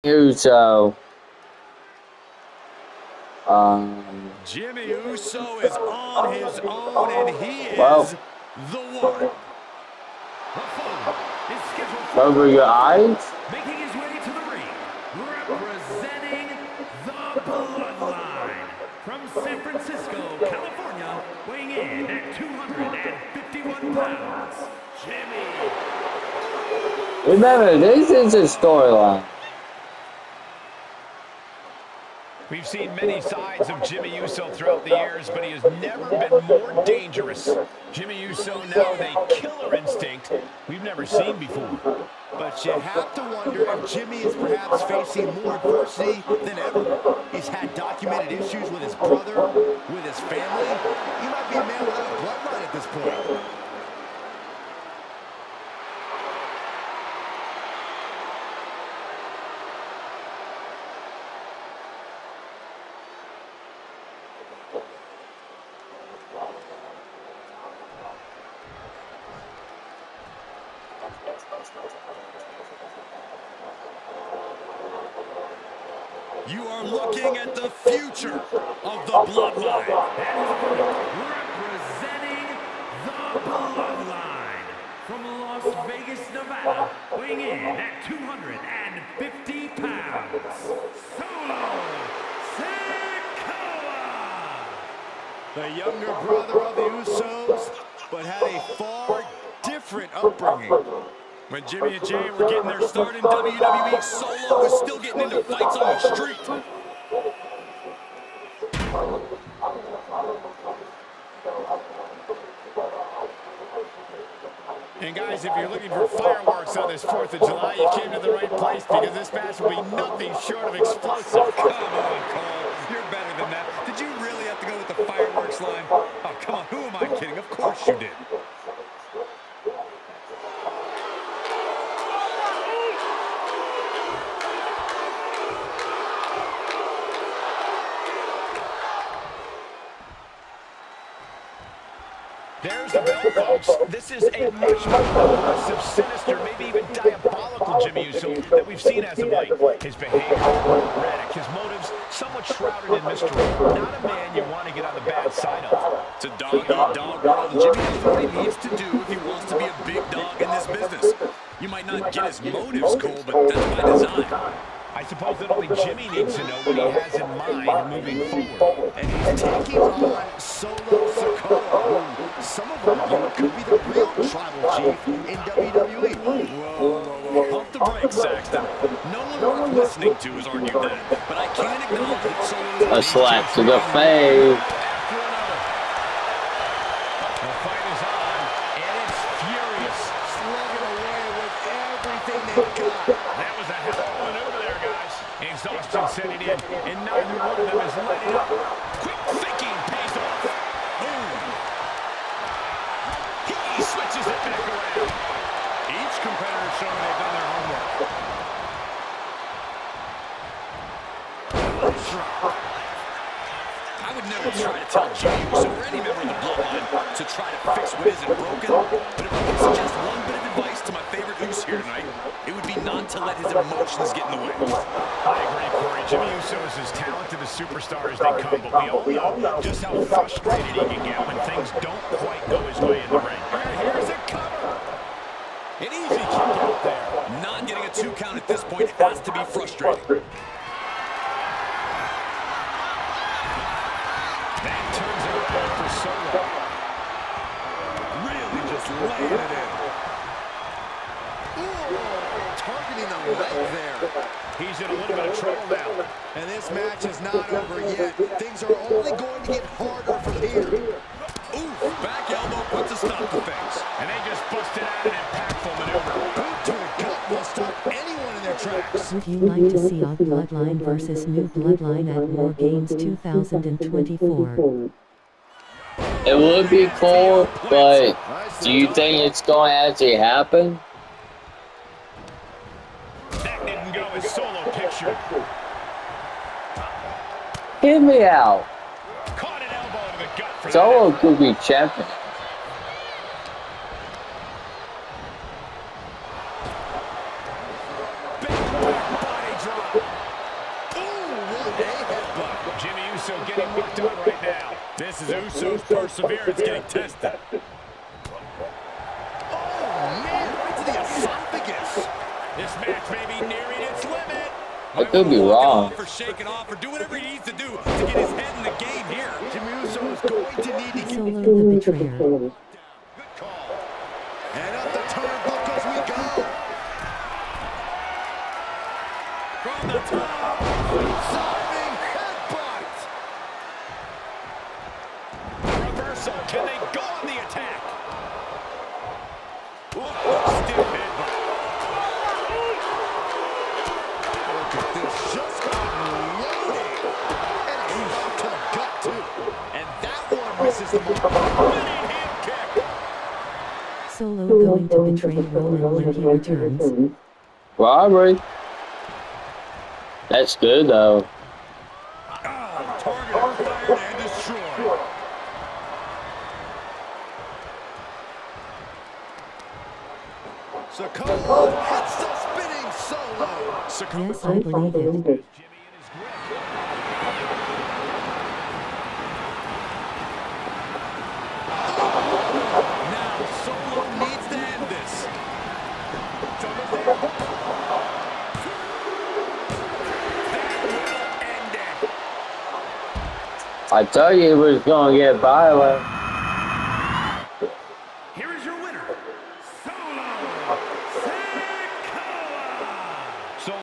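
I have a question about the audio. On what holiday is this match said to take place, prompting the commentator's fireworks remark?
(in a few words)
4th of July.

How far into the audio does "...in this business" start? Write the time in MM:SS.
02:40.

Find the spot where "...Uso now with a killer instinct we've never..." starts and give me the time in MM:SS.
00:38.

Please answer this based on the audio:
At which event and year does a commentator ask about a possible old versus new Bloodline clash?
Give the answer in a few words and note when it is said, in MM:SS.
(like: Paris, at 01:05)
War Games 2024, at 04:32.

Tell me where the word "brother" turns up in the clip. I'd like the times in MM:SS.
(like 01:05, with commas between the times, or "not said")
00:48, 01:36.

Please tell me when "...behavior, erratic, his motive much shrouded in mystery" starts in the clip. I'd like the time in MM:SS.
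02:29.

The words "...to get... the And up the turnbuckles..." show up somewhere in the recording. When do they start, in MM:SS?
05:21.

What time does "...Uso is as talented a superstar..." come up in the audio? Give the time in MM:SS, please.
03:46.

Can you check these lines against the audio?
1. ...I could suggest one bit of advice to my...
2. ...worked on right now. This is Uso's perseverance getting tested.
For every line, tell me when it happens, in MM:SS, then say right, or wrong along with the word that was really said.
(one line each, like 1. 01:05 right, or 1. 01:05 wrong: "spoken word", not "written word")
1. 03:39 right
2. 05:03 right.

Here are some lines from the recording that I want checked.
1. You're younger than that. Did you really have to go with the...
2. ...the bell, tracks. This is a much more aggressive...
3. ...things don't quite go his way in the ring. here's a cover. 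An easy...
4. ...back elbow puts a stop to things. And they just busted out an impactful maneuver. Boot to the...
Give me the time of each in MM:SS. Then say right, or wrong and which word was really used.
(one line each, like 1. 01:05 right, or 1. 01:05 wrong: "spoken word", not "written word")
1. 02:02 wrong: "better", not "younger"
2. 02:22 wrong: "folks", not "tracks"
3. 03:51 right
4. 04:22 right.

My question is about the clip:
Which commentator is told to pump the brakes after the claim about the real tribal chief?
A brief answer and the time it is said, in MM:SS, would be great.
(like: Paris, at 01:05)
Saxton, at 02:58.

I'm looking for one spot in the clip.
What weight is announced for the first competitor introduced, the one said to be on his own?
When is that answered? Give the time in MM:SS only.
00:22.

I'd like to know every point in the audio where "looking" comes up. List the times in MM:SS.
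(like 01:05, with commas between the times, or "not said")
01:16, 01:55.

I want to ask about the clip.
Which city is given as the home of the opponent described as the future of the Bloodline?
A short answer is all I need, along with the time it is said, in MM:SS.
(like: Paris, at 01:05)
Las Vegas, Nevada, at 01:25.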